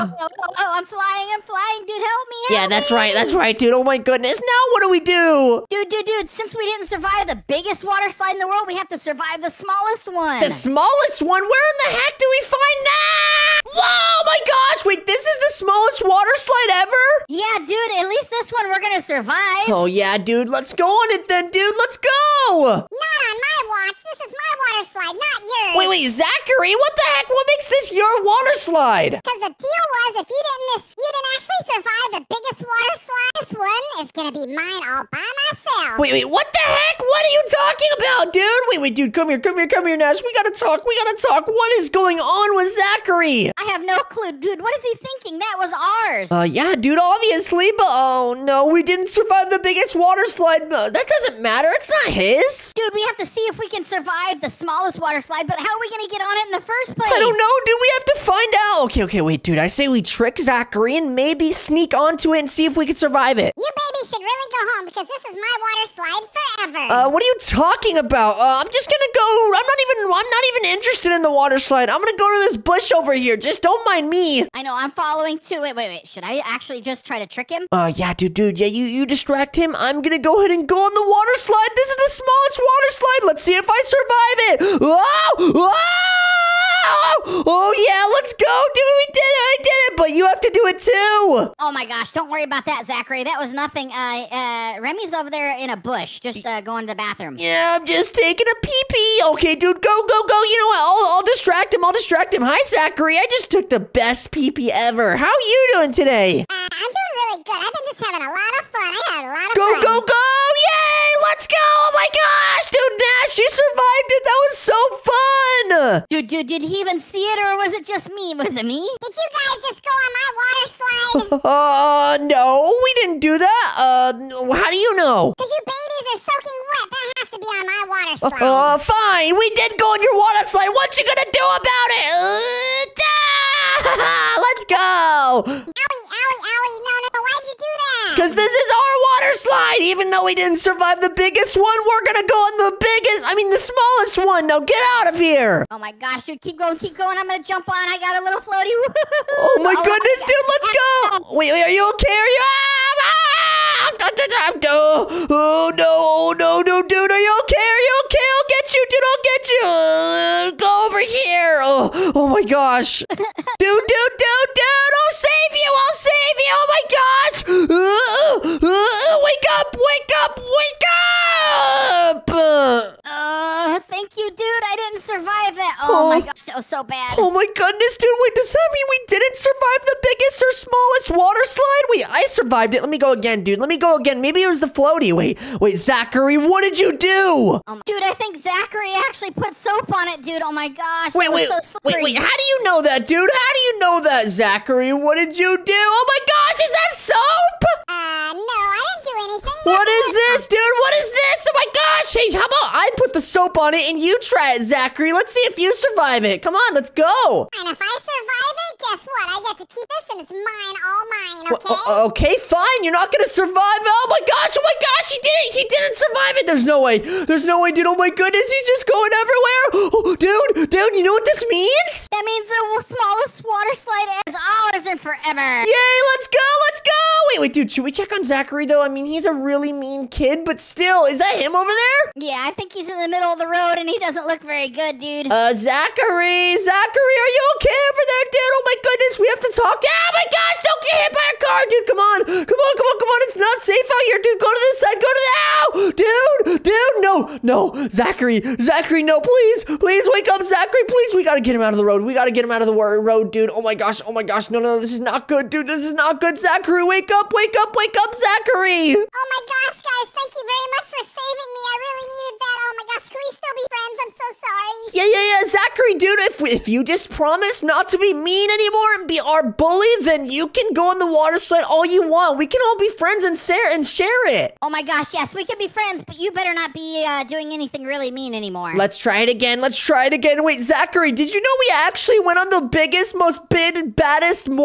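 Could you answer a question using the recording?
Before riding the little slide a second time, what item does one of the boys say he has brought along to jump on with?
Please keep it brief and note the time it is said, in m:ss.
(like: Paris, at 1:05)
A little floaty, at 2:28.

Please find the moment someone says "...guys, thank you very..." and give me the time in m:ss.
4:19.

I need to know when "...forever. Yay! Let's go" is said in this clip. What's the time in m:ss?
3:44.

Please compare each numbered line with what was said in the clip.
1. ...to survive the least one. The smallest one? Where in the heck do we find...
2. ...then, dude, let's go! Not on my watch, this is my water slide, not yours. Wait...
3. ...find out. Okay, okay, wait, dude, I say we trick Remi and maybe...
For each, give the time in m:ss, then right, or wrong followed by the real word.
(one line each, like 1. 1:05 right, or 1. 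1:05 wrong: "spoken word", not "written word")
1. 0:08 wrong: "smallest", not "least"
2. 0:21 right
3. 0:58 wrong: "Zachary", not "Remi".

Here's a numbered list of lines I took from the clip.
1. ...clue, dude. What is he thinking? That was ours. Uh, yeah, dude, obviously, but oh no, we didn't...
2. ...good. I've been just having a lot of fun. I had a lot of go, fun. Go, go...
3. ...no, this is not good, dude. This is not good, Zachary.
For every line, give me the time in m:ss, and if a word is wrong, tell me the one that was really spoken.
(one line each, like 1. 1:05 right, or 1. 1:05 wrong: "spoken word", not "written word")
1. 0:44 right
2. 1:47 right
3. 4:14 right.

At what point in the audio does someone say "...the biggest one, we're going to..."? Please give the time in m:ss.
2:21.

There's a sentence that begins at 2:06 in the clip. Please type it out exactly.
That has to be on my water uh, slide.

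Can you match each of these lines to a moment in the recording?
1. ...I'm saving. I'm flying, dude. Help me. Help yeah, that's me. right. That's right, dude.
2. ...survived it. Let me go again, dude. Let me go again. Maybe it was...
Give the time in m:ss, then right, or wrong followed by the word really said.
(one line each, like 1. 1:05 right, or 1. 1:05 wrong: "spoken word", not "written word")
1. 0:00 wrong: "flying", not "saving"
2. 3:02 right.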